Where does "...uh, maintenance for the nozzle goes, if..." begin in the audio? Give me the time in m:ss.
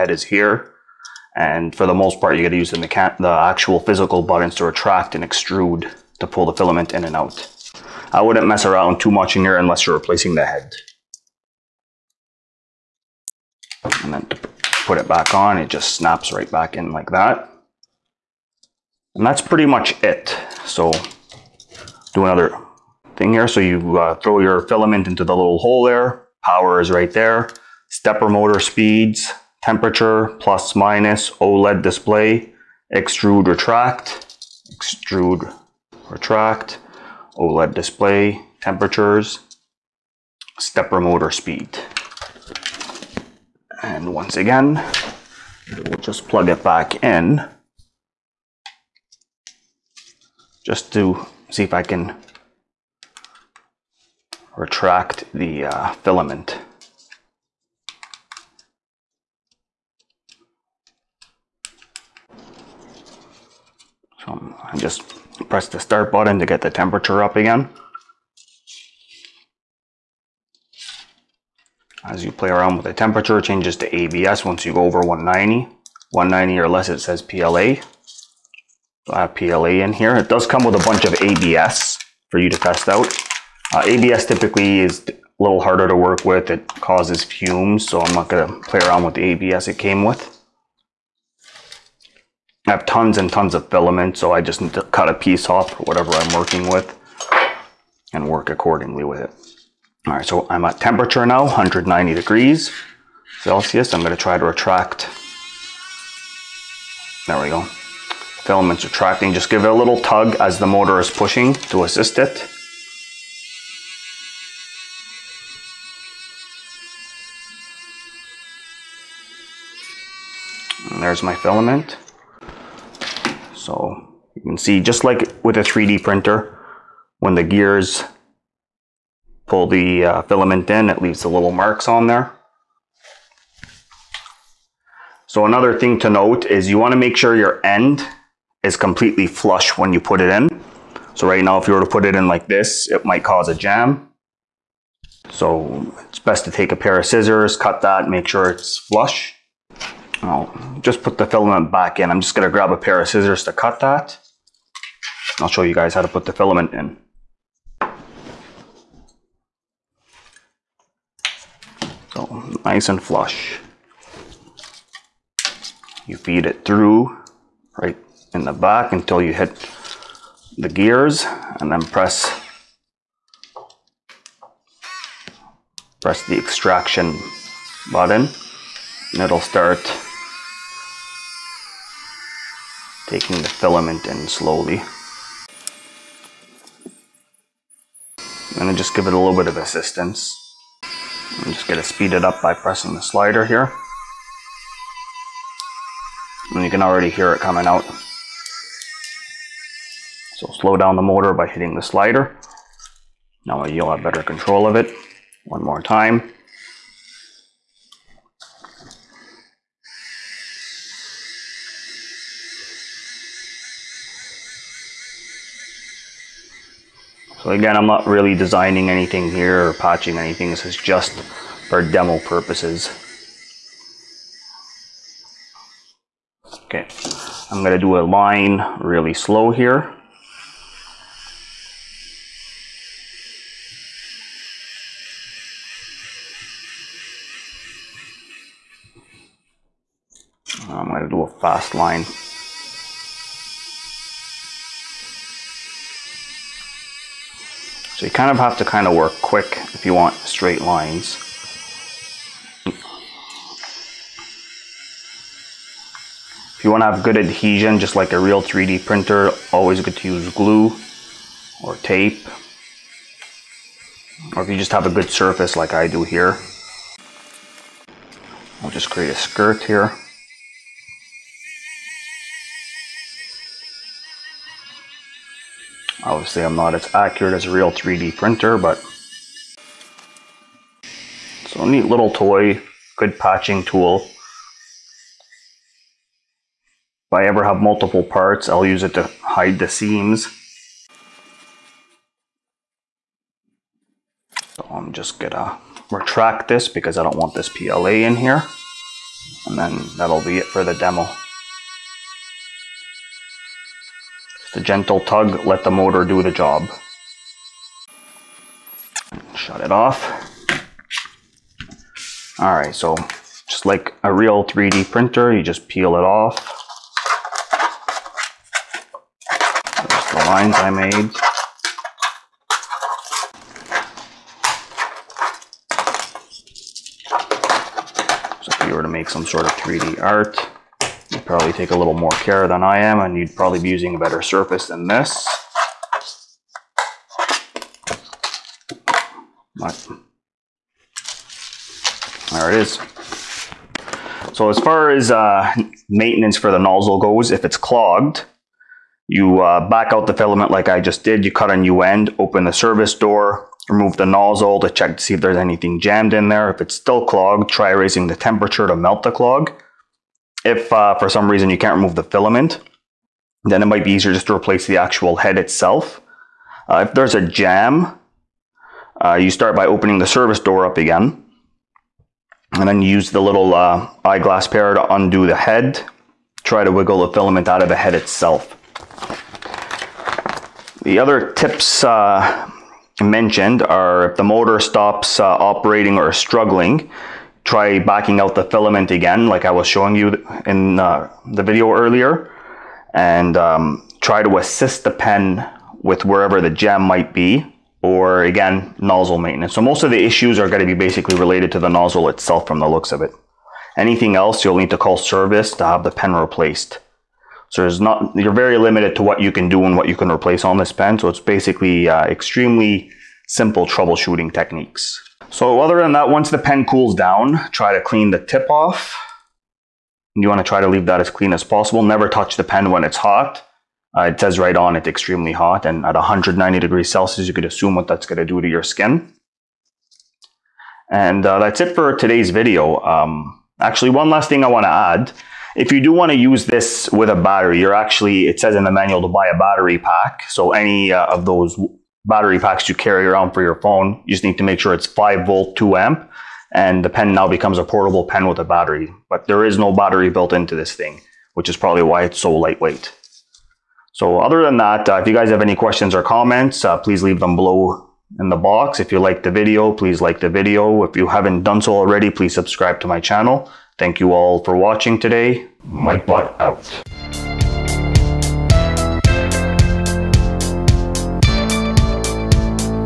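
5:45.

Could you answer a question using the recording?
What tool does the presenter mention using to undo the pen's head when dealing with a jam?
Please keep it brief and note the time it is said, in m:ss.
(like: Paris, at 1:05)
Eyeglass pair, at 6:14.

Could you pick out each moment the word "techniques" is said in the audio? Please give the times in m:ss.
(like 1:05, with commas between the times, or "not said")
6:54.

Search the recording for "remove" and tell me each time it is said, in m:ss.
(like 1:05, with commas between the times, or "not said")
5:53, 6:01.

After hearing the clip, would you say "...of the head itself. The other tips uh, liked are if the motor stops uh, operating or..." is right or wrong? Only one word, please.
wrong.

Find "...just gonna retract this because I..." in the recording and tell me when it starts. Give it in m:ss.
4:54.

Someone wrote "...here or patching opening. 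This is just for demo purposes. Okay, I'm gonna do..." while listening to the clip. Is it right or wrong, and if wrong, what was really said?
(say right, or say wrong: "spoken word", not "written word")
wrong: "anything", not "opening".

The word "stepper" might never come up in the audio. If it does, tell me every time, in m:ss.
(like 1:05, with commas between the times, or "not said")
0:27, 0:40.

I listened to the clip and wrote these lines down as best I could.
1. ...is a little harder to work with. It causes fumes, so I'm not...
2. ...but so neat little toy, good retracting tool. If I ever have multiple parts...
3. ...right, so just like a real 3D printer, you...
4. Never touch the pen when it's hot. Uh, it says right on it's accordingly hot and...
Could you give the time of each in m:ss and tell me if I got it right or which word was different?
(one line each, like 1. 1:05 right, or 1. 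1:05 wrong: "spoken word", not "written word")
1. 1:24 right
2. 4:38 wrong: "patching", not "retracting"
3. 5:12 right
4. 7:01 wrong: "extremely", not "accordingly".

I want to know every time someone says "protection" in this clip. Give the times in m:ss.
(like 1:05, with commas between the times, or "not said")
not said.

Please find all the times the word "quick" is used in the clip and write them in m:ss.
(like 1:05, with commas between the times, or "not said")
4:09.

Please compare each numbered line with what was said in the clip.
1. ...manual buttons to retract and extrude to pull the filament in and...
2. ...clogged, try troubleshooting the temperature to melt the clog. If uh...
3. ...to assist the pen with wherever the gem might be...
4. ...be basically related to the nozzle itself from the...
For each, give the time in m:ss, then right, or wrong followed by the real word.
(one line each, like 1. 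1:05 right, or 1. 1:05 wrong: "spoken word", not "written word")
1. 0:03 wrong: "physical", not "manual"
2. 5:57 wrong: "raising", not "troubleshooting"
3. 6:34 right
4. 6:40 right.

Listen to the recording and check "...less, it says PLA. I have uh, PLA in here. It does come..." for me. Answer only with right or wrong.
right.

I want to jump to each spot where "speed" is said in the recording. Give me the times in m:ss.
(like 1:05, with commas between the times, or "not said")
0:28, 0:41, 3:11.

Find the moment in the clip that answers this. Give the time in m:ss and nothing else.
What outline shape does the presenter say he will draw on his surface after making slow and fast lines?
4:29.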